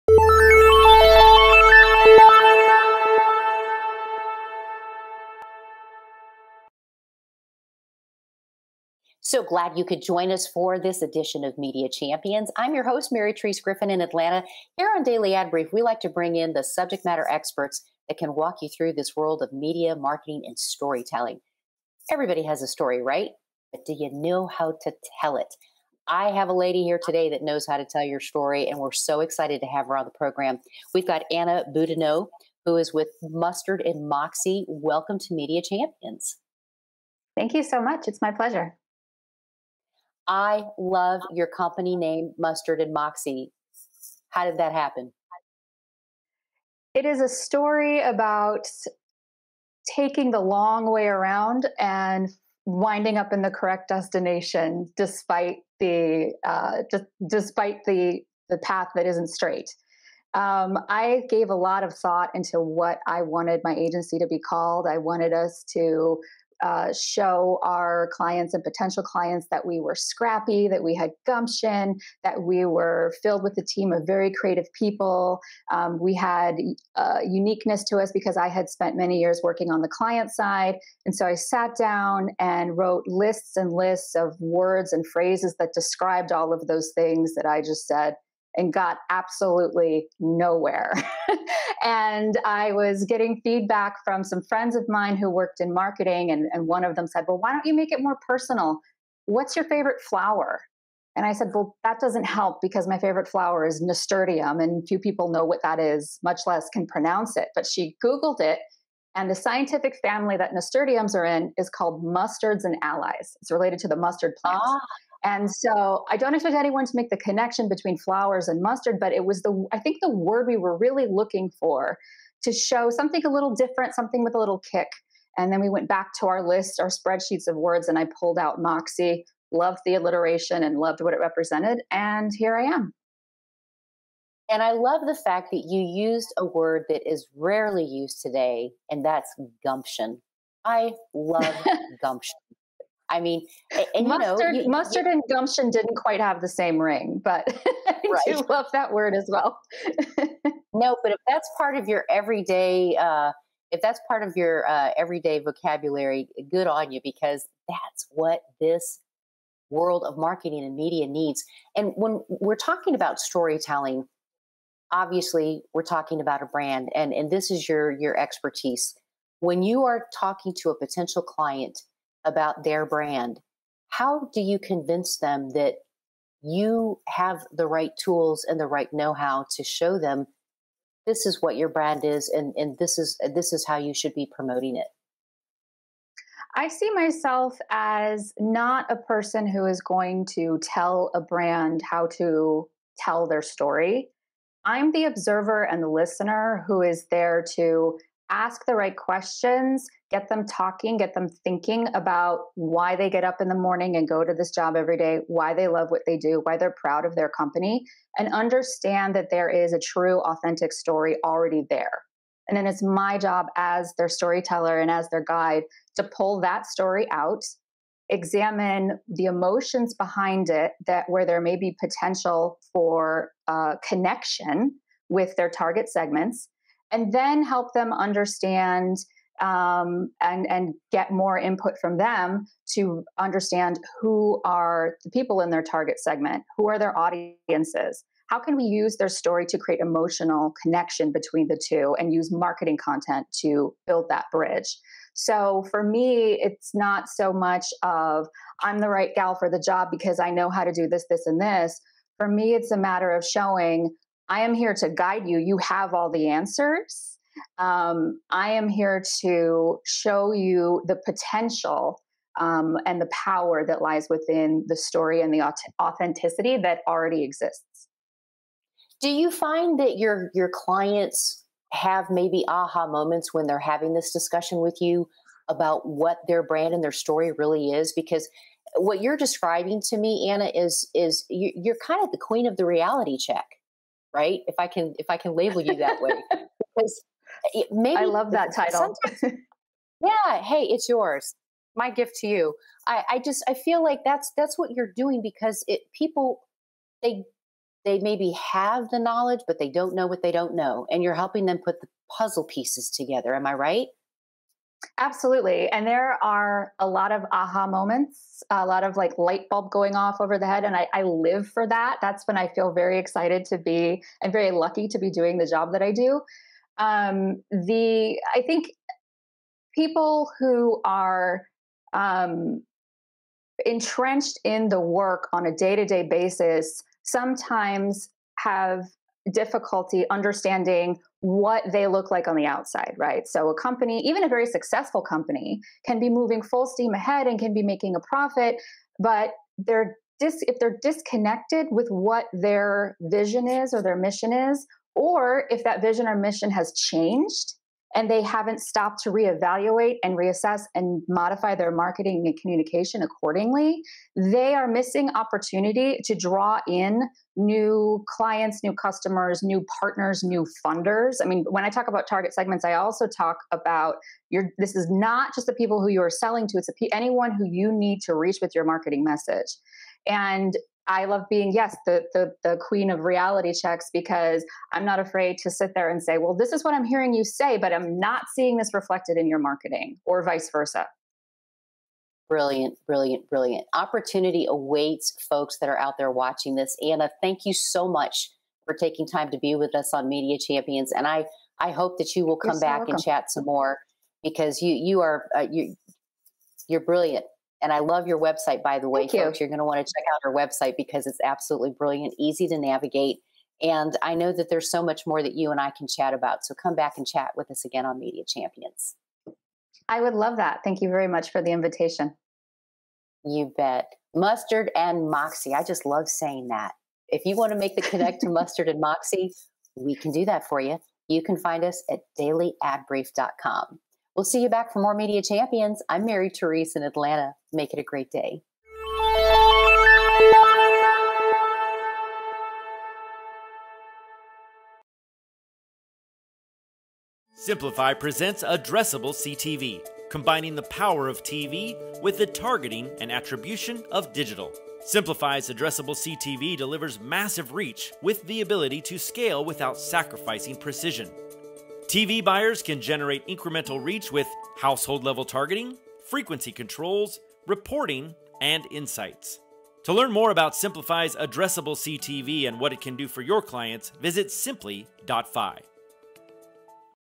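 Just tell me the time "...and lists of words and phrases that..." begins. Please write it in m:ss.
1:23.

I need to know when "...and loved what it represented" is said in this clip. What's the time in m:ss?
2:10.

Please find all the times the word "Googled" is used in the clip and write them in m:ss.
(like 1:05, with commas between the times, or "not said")
1:48.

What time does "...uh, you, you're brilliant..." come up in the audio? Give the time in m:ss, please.
6:35.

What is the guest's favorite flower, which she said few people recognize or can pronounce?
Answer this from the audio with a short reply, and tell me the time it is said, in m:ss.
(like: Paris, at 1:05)
nasturtium, at 1:43.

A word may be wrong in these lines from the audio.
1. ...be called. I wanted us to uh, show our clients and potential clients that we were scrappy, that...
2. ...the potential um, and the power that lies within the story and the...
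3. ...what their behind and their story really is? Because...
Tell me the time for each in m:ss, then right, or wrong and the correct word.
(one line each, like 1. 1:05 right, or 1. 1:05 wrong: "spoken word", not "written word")
1. 1:04 right
2. 4:20 right
3. 4:35 wrong: "brand", not "behind".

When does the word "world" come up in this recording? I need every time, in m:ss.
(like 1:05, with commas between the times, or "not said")
0:19, 2:39.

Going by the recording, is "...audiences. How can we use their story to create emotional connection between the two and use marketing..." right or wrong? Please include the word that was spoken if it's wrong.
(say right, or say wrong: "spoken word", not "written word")
right.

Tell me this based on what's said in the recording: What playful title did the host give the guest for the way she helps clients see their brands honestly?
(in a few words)
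queen of the reality check.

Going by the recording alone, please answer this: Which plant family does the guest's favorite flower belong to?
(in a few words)
mustards and allies.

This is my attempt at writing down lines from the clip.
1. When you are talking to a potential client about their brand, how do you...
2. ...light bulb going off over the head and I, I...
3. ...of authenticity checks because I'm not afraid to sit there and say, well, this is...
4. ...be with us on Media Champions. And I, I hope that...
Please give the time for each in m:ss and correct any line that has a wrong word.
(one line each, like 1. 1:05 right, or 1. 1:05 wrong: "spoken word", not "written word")
1. 2:49 right
2. 5:09 right
3. 6:12 wrong: "reality", not "authenticity"
4. 6:29 right.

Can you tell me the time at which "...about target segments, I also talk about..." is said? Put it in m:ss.
6:01.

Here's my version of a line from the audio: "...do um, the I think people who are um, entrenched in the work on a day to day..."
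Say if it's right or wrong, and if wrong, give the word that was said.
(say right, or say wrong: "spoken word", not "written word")
right.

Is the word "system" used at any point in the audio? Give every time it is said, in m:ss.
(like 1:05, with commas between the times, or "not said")
not said.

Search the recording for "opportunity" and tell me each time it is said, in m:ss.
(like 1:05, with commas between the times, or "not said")
5:55, 6:23.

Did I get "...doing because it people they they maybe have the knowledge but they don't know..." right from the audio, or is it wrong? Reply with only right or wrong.
right.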